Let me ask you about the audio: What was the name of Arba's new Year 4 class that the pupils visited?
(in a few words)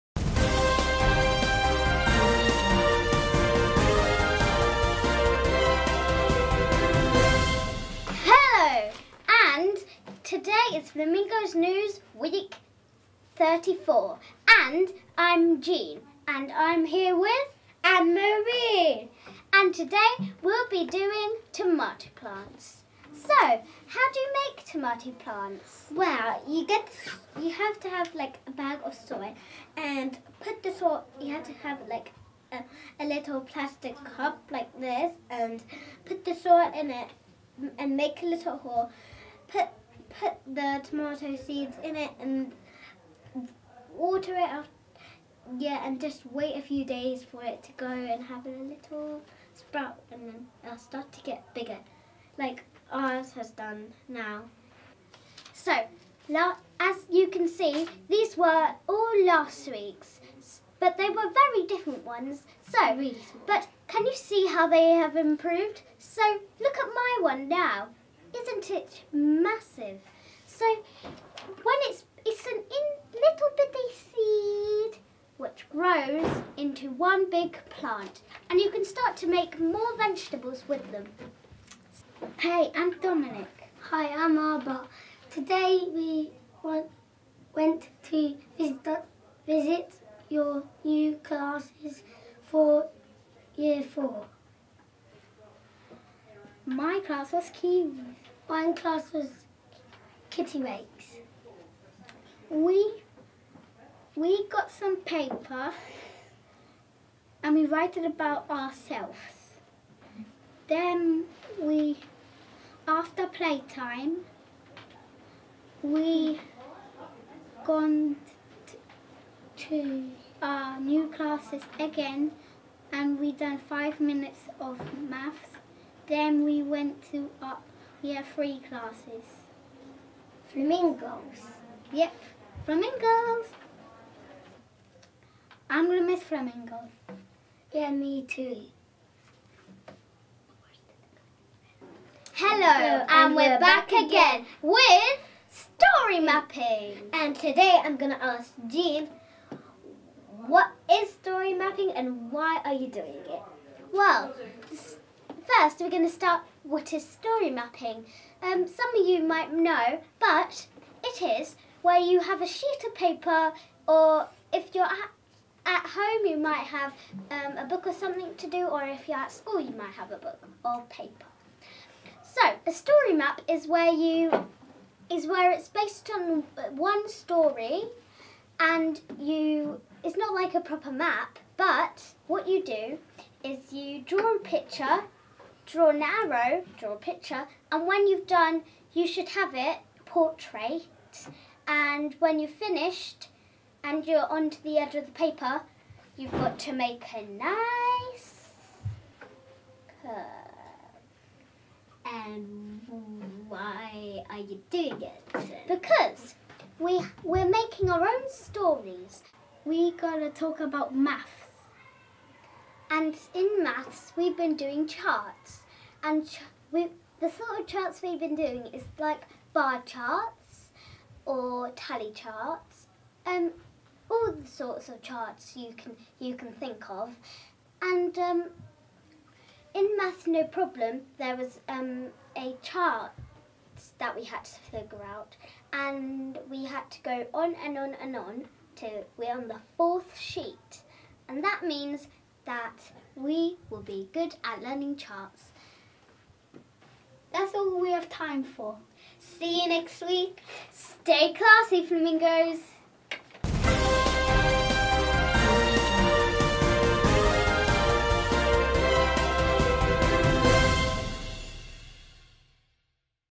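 Kittiwakes.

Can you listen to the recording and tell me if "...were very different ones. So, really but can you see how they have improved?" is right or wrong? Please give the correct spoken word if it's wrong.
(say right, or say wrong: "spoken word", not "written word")
right.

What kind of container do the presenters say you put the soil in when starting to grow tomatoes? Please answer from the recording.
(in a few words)
plastic cup.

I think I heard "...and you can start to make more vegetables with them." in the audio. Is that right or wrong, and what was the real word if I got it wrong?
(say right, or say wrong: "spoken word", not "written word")
right.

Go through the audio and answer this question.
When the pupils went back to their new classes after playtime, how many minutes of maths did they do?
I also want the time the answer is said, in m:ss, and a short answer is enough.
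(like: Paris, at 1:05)
5, at 2:03.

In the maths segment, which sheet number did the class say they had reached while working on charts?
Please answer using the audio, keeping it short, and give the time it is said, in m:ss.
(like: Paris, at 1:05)
4th, at 3:59.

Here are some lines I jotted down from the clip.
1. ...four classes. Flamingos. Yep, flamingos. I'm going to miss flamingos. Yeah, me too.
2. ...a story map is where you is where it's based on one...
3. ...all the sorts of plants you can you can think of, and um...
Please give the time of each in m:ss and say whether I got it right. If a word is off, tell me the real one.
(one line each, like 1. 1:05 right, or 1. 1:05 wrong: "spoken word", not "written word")
1. 2:08 wrong: "three", not "four"
2. 2:52 right
3. 3:44 wrong: "charts", not "plants".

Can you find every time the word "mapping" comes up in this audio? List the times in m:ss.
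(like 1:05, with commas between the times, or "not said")
2:26, 2:31, 2:37.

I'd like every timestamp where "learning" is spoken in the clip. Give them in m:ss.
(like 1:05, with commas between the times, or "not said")
4:04.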